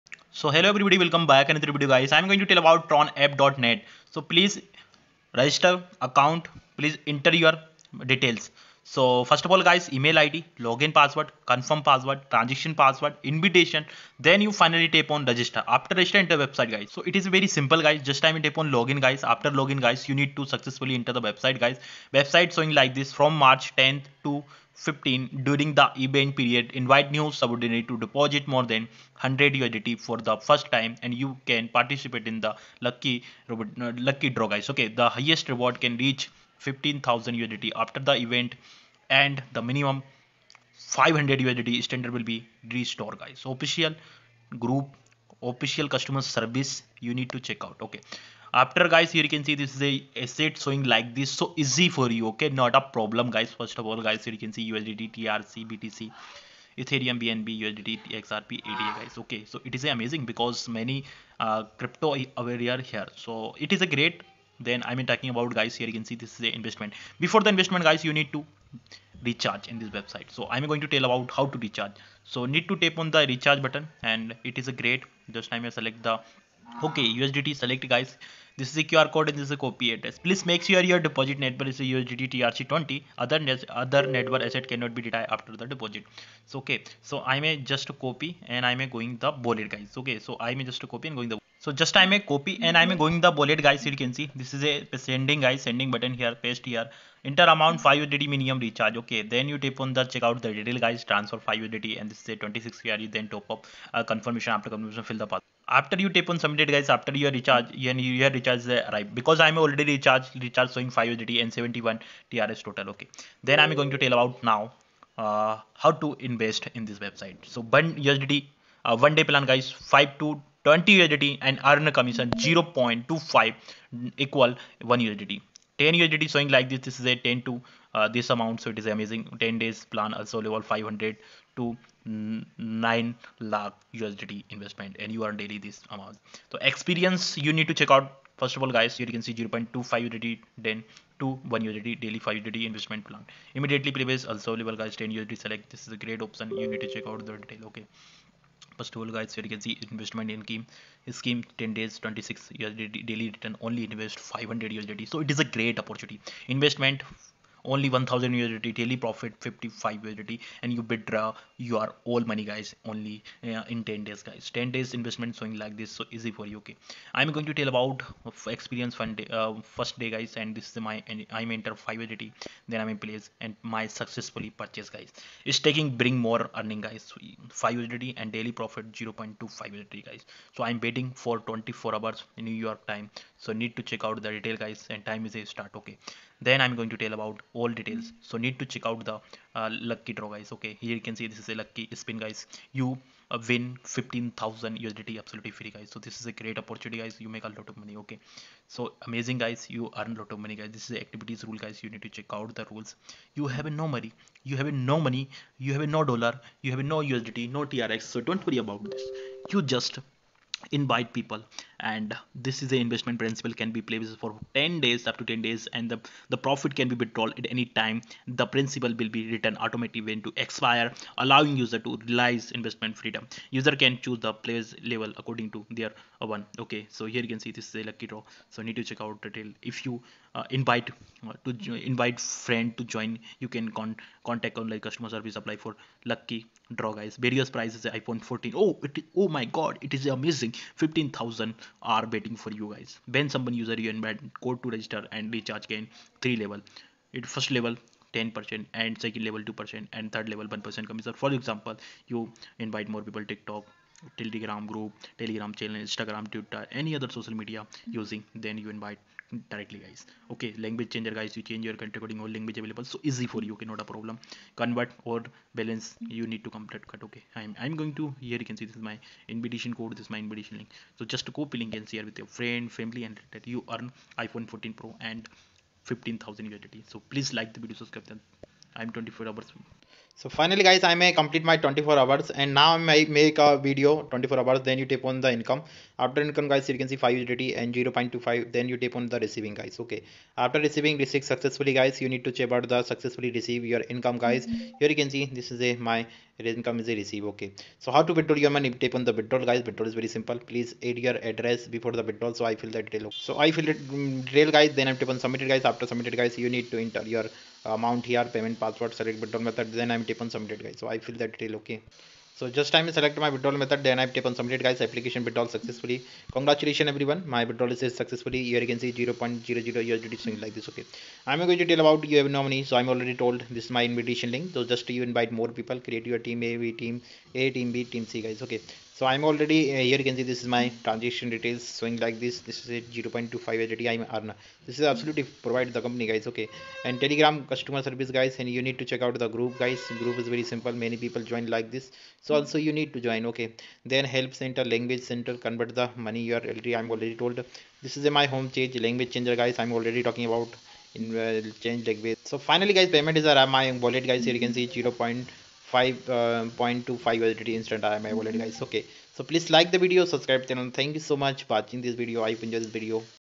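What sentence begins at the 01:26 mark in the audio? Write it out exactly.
So okay, so I may just copy and I may going the bullet guys.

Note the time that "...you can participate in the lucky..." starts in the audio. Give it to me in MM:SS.
00:31.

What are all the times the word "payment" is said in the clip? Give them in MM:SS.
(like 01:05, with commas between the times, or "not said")
05:08, 05:52.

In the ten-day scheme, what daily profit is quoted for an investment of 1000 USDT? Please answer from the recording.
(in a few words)
55 USDT.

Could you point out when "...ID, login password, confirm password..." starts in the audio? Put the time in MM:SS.
00:10.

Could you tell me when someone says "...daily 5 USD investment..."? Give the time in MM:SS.
02:22.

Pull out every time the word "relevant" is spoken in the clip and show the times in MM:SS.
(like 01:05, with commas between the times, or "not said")
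not said.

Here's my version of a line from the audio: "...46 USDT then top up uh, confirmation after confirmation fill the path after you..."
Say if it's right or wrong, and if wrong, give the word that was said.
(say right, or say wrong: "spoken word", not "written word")
wrong: "26", not "46".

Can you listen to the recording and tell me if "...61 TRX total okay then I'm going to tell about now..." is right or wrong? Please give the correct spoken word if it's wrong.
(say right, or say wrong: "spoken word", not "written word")
wrong: "71", not "61".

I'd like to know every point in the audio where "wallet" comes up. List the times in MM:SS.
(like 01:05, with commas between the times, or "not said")
05:53, 05:58.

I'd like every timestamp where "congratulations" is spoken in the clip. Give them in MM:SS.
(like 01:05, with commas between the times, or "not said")
05:16.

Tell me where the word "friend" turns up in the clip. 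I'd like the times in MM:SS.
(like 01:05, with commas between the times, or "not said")
03:52, 04:32.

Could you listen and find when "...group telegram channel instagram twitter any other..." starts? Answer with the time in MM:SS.
04:14.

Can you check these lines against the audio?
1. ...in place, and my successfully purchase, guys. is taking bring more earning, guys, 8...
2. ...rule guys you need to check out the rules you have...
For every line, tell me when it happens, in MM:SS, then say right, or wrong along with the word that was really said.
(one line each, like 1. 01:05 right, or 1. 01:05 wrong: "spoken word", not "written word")
1. 02:52 wrong: "5", not "8"
2. 03:21 right.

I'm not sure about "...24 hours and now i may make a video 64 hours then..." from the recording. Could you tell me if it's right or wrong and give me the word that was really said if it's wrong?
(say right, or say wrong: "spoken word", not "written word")
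wrong: "24", not "64".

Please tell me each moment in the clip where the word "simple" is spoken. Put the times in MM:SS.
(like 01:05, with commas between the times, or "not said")
00:17, 05:00, 05:40.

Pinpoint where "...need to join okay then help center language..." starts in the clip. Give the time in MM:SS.
05:42.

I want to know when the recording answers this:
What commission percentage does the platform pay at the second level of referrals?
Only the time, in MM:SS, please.
04:09.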